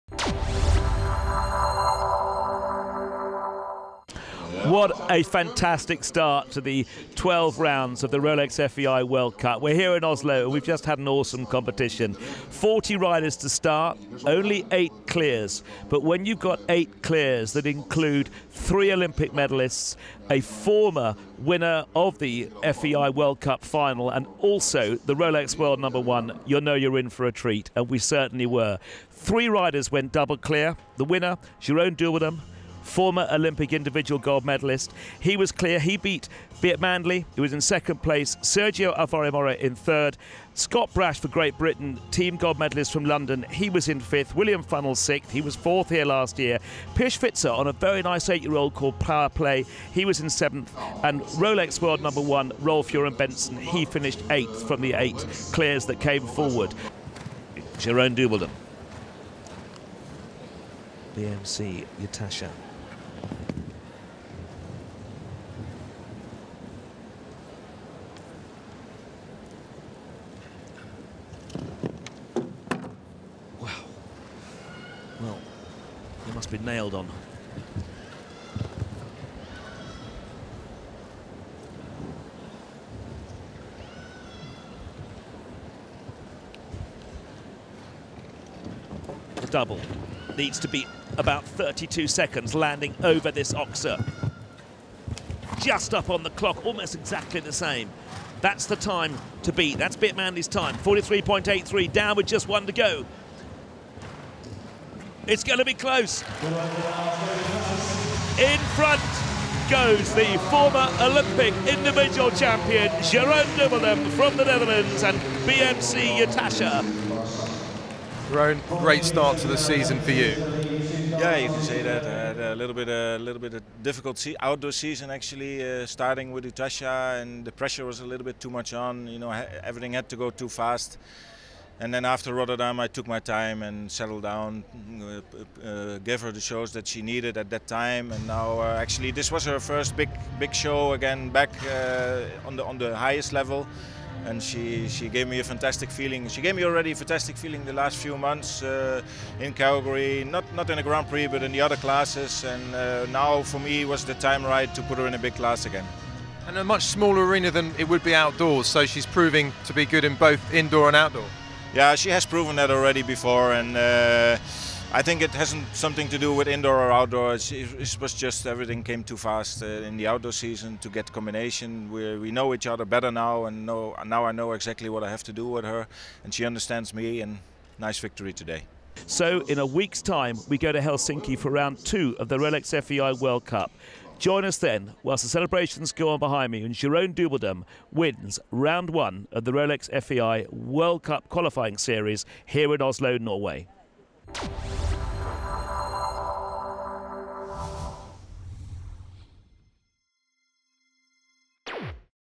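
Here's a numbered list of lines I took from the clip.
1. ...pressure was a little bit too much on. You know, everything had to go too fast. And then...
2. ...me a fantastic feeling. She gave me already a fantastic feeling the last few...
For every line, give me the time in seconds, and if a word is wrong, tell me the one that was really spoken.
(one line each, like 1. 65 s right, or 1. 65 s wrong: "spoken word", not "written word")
1. 127 s right
2. 145 s right.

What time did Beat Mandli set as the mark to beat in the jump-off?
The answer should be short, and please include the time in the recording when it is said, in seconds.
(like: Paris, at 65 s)
43.83, at 100 s.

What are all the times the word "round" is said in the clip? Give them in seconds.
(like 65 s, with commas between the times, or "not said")
7 s, 181 s, 188 s.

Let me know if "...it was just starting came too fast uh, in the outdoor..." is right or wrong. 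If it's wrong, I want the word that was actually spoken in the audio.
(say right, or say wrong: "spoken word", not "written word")
wrong: "everything", not "starting".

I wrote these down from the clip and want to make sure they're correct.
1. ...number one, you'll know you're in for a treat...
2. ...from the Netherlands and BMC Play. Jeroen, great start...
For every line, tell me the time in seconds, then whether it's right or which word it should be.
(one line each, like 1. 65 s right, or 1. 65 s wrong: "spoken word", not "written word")
1. 25 s right
2. 114 s wrong: "Utascha", not "Play".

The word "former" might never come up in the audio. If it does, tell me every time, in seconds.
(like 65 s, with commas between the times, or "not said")
20 s, 32 s, 110 s.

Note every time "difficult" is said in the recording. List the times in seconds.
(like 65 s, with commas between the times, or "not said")
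123 s.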